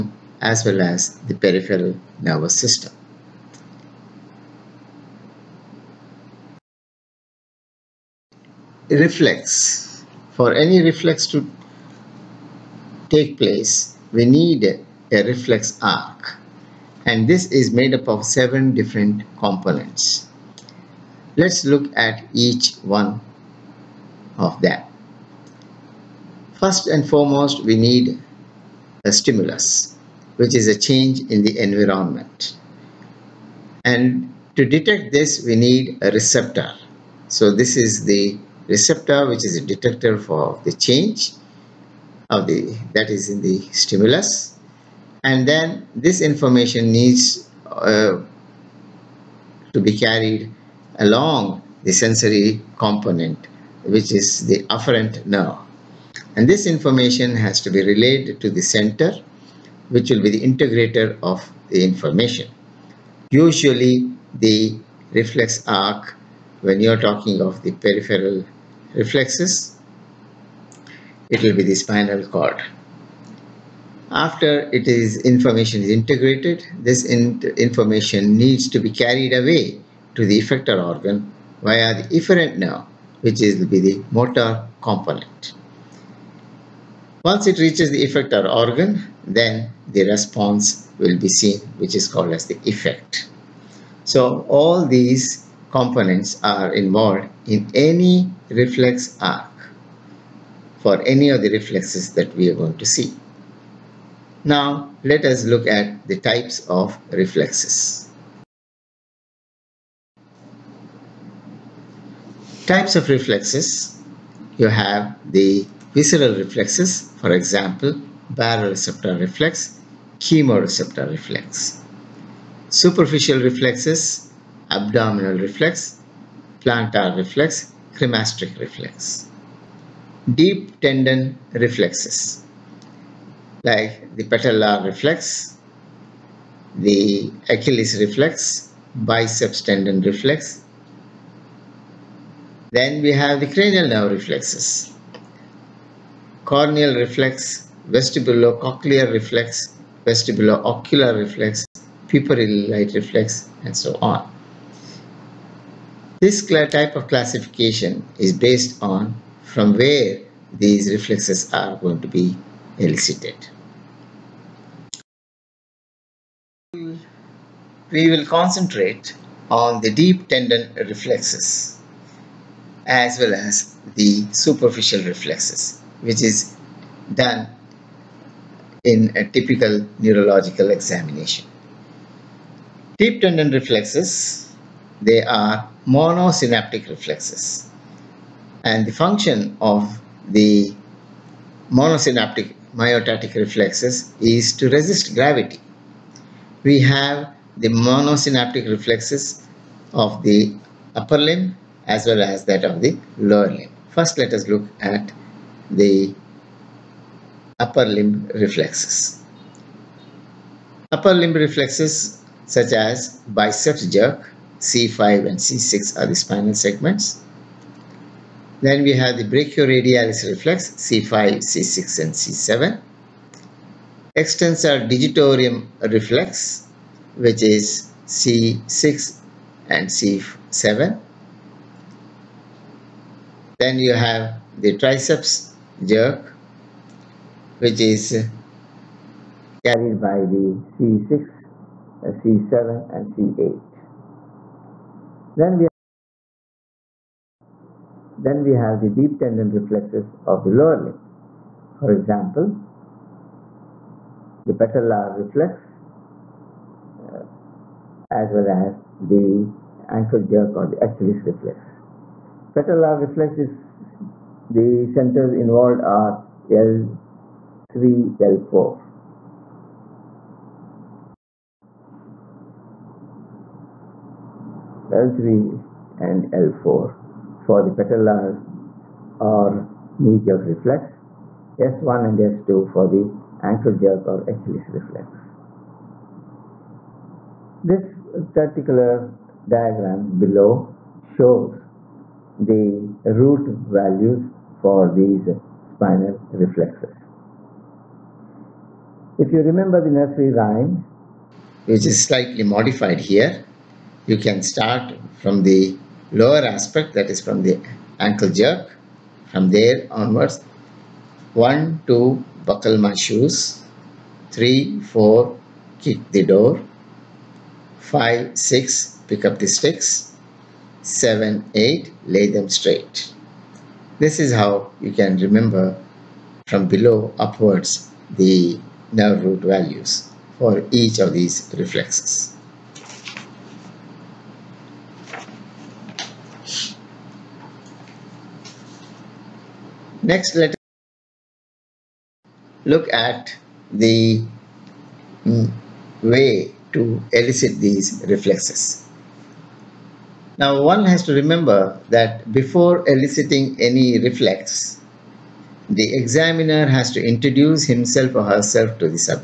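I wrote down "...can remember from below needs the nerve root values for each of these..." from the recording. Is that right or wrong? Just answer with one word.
wrong.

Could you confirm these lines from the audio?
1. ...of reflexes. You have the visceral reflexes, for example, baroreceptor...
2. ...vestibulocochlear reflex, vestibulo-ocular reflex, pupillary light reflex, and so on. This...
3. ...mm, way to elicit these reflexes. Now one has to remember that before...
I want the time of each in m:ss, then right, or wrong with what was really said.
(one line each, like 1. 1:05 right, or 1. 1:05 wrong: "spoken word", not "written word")
1. 1:52 right
2. 2:27 right
3. 5:45 right.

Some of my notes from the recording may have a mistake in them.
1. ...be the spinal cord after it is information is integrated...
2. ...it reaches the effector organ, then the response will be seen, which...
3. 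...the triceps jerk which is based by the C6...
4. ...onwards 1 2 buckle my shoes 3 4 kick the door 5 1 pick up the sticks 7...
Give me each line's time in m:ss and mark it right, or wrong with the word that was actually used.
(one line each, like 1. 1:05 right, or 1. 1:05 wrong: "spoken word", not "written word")
1. 1:11 right
2. 1:27 right
3. 3:54 wrong: "carried", not "based"
4. 5:09 wrong: "6", not "1".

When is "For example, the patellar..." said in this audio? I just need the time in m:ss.
4:11.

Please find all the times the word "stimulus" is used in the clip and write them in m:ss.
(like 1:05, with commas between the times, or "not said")
0:29, 0:43.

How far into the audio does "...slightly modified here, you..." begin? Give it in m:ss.
5:02.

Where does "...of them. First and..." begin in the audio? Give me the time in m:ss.
0:24.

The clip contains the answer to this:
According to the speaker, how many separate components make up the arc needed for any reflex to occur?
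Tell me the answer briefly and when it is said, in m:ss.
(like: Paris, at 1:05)
7, at 0:18.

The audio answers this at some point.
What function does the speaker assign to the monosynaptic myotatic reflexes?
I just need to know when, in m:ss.
3:14.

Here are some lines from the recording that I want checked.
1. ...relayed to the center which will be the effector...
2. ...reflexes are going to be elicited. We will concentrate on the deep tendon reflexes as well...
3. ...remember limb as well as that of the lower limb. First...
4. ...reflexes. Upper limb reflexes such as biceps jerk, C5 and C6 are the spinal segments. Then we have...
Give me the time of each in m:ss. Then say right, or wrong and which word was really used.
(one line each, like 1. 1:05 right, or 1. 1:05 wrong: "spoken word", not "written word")
1. 0:57 wrong: "integrator", not "effector"
2. 2:40 right
3. 3:20 wrong: "upper", not "remember"
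4. 3:28 right.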